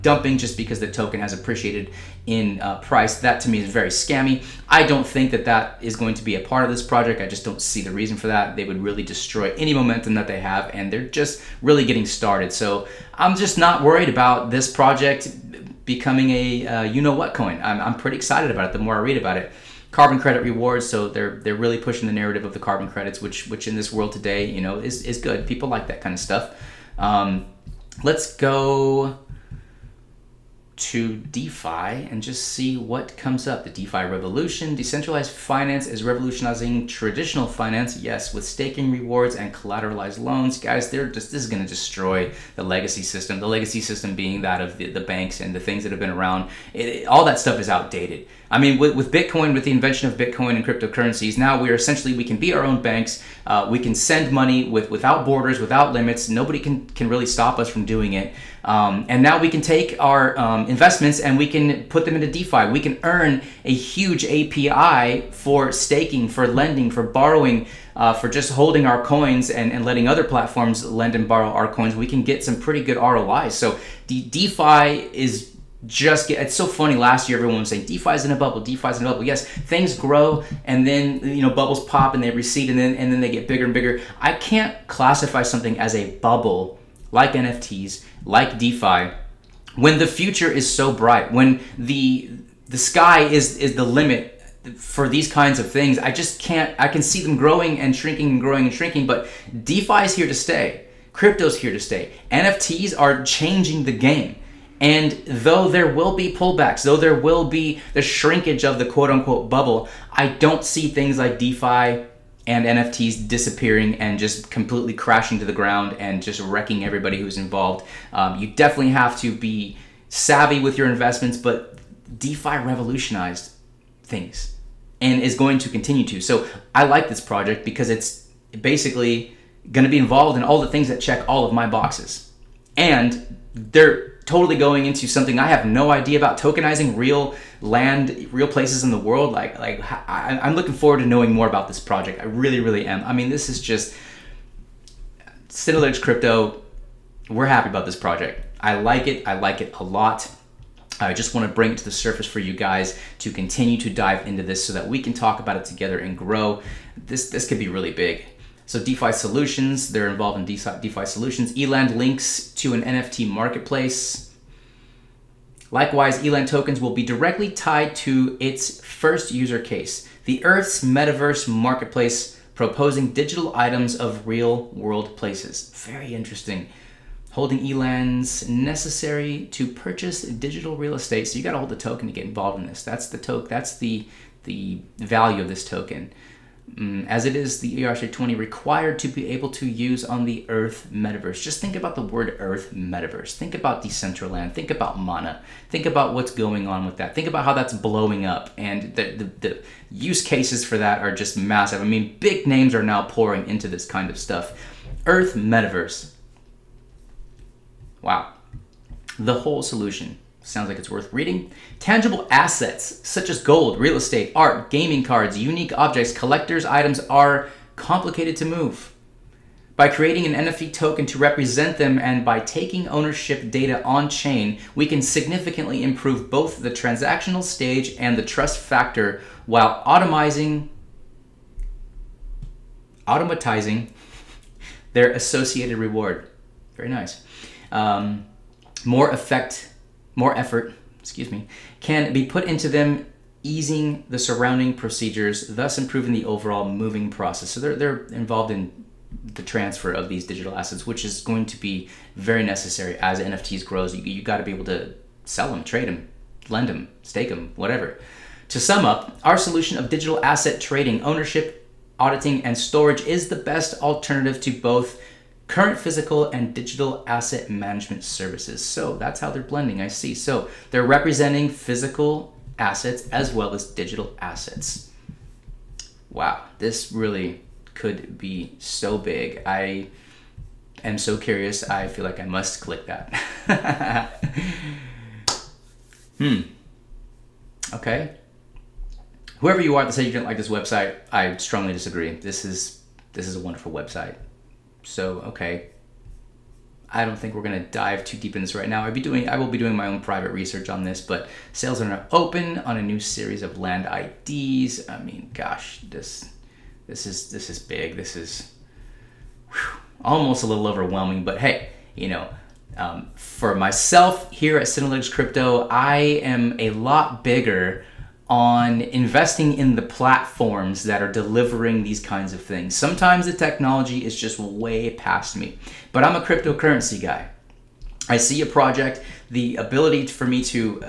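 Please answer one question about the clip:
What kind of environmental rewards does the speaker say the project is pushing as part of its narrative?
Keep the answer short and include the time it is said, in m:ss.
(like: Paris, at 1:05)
carbon credit rewards, at 0:19.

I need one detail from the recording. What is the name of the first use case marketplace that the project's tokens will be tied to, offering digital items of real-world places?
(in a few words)
Earth's metaverse marketplace.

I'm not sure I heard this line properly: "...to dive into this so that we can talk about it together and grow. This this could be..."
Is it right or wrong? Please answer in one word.
right.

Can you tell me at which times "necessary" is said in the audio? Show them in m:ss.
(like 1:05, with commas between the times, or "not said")
2:58, 4:12.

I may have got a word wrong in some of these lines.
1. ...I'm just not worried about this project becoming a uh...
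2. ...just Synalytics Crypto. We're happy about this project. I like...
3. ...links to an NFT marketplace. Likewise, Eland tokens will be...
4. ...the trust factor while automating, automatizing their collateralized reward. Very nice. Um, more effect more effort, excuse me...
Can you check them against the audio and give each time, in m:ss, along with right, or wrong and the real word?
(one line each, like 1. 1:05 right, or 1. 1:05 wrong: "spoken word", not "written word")
1. 0:13 right
2. 2:23 right
3. 2:41 right
4. 3:48 wrong: "associated", not "collateralized".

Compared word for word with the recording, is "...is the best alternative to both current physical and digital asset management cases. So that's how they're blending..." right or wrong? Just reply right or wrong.
wrong.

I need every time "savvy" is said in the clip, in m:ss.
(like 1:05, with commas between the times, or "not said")
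2:00.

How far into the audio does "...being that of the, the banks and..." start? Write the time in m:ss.
0:44.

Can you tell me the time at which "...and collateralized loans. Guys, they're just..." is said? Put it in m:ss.
0:39.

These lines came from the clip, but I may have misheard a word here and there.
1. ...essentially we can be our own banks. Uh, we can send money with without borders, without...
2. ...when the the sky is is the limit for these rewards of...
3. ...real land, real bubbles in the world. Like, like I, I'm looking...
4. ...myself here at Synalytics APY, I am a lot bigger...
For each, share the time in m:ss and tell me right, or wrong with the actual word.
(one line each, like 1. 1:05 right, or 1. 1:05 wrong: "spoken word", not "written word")
1. 0:51 right
2. 1:31 wrong: "kinds", not "rewards"
3. 2:16 wrong: "places", not "bubbles"
4. 5:13 wrong: "Crypto", not "APY".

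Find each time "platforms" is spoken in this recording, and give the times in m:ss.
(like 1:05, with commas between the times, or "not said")
1:10, 5:19.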